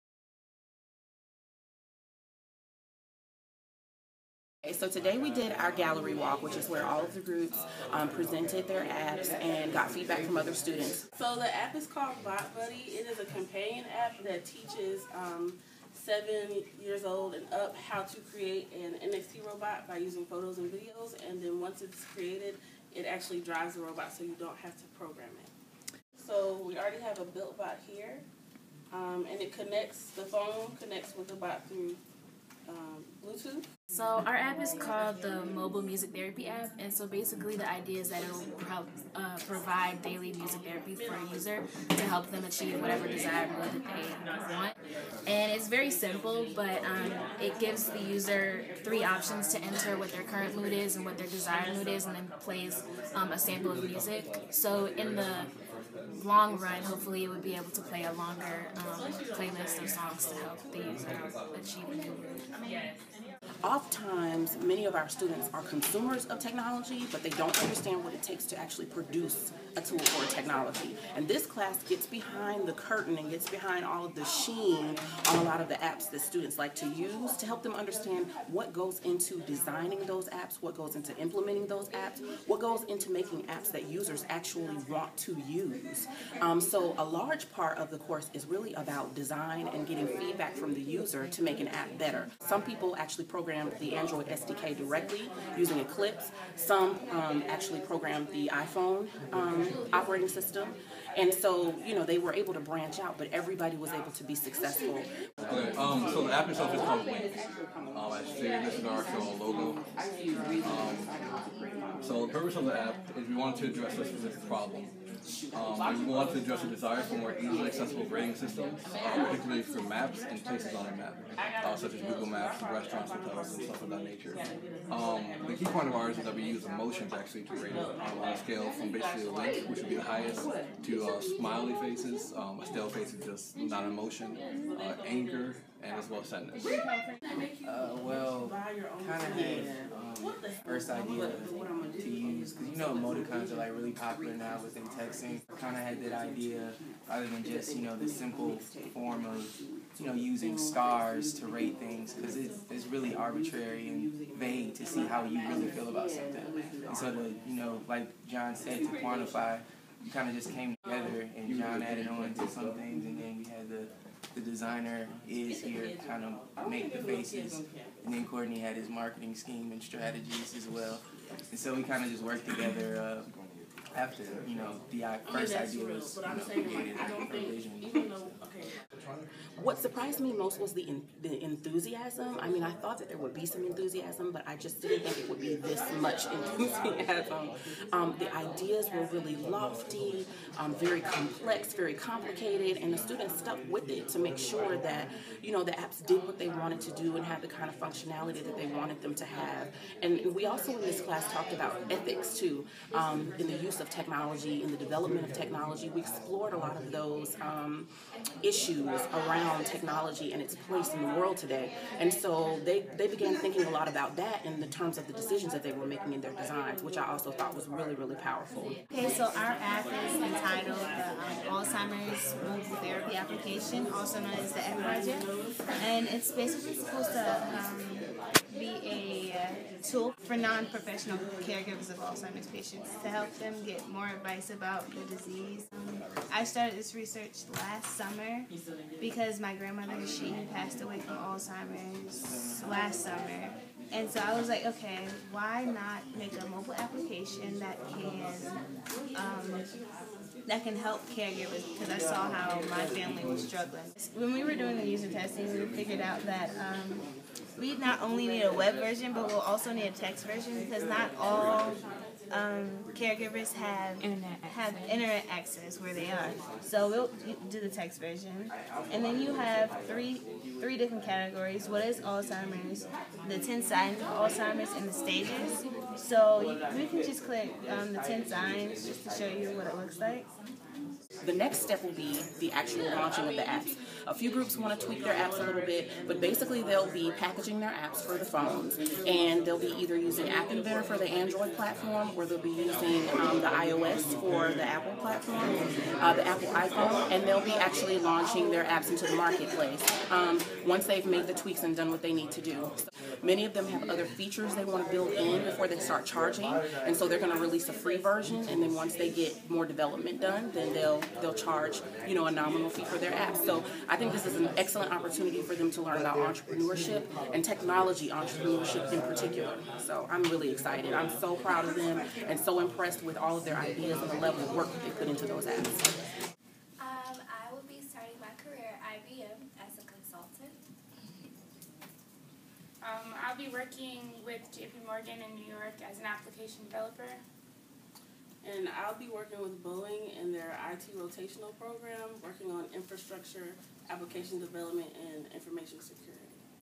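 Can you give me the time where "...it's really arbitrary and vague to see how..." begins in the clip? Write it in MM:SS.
02:32.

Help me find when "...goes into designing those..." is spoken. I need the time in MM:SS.
01:18.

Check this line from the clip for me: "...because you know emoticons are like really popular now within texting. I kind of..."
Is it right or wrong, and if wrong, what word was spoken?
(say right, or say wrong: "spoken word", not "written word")
right.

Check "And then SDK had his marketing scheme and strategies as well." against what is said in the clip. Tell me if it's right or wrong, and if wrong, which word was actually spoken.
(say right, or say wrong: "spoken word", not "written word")
wrong: "Courtney", not "SDK".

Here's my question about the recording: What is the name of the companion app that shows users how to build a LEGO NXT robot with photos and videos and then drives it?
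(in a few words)
Bot Buddy.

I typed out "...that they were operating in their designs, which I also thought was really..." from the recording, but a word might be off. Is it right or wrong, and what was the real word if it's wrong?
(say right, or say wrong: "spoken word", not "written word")
wrong: "making", not "operating".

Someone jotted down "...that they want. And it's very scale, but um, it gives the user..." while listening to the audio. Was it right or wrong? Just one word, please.
wrong.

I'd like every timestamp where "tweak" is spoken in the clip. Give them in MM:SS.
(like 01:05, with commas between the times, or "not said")
04:44, 05:01.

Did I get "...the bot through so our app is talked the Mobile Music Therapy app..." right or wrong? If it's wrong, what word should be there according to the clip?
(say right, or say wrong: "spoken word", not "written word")
wrong: "called", not "talked".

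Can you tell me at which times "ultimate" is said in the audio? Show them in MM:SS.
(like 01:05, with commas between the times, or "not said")
not said.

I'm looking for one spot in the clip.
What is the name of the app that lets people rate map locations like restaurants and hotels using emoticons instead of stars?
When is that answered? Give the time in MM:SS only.
01:47.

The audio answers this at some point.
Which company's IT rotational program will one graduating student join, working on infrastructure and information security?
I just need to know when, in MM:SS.
05:39.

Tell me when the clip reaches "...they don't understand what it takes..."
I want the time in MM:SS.
01:07.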